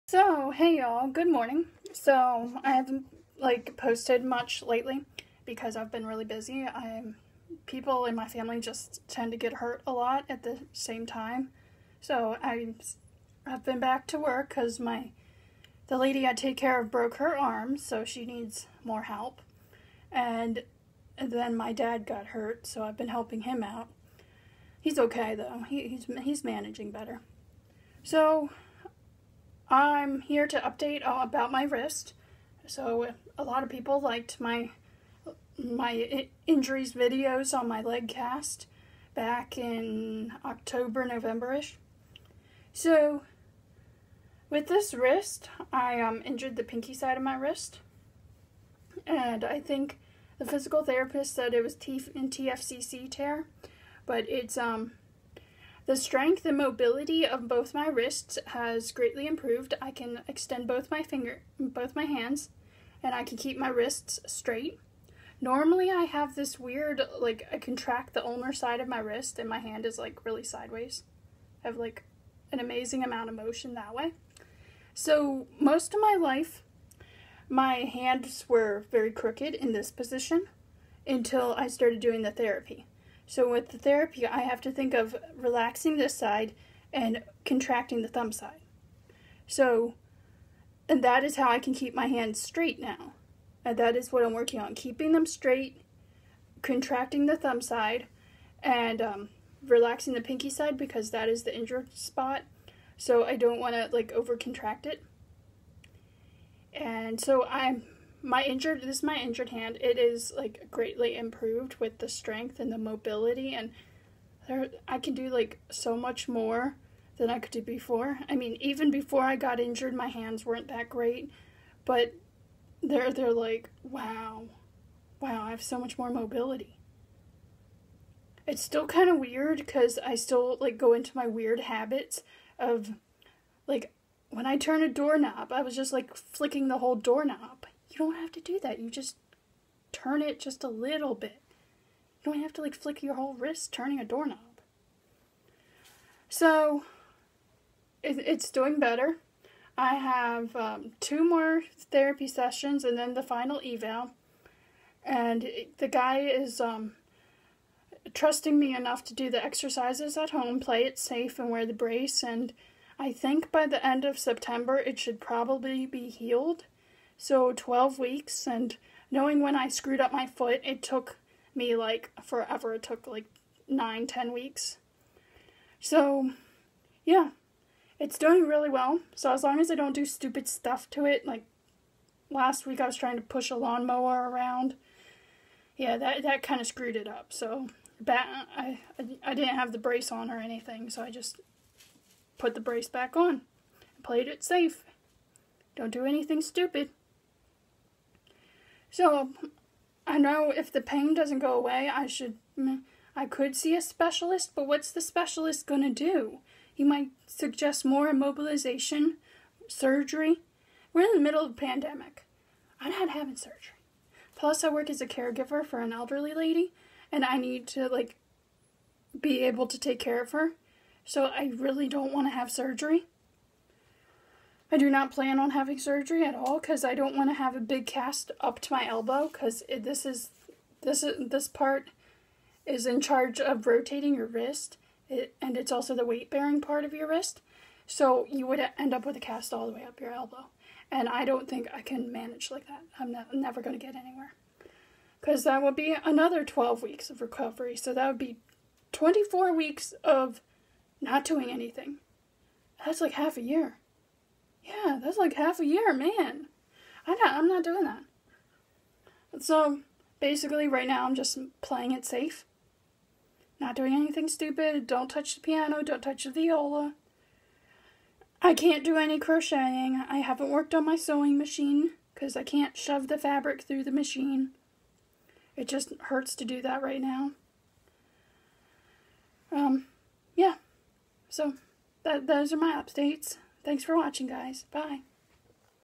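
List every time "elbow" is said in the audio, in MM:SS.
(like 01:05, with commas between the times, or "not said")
03:48, 04:00.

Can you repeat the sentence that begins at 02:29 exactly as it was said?
I have um, two more therapy sessions and then the final eval.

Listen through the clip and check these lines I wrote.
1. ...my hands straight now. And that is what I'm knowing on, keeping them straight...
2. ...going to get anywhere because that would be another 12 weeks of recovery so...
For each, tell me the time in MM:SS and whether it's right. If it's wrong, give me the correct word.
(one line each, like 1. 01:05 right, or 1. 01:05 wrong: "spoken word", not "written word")
1. 01:31 wrong: "working", not "knowing"
2. 04:03 right.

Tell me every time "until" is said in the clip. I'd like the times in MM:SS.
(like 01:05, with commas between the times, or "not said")
01:21.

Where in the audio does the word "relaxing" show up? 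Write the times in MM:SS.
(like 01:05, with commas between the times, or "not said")
01:25, 01:39.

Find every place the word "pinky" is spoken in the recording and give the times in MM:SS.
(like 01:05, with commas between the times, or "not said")
00:46, 01:40.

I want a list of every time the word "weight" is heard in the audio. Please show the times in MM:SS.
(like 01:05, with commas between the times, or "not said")
03:56.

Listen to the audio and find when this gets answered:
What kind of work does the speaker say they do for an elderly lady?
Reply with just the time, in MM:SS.
03:35.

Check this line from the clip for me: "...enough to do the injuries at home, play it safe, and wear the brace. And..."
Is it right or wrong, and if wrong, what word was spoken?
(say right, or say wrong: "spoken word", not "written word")
wrong: "exercises", not "injuries".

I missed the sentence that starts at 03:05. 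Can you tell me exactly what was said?
Yeah, that that kind of screwed it up.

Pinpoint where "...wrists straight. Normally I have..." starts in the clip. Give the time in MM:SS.
01:03.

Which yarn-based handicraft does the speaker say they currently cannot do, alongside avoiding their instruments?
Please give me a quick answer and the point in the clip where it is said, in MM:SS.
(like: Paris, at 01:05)
crocheting, at 04:29.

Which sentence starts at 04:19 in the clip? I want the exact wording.
So basically, right now, I'm just playing it safe.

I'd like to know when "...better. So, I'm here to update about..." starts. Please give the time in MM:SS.
00:26.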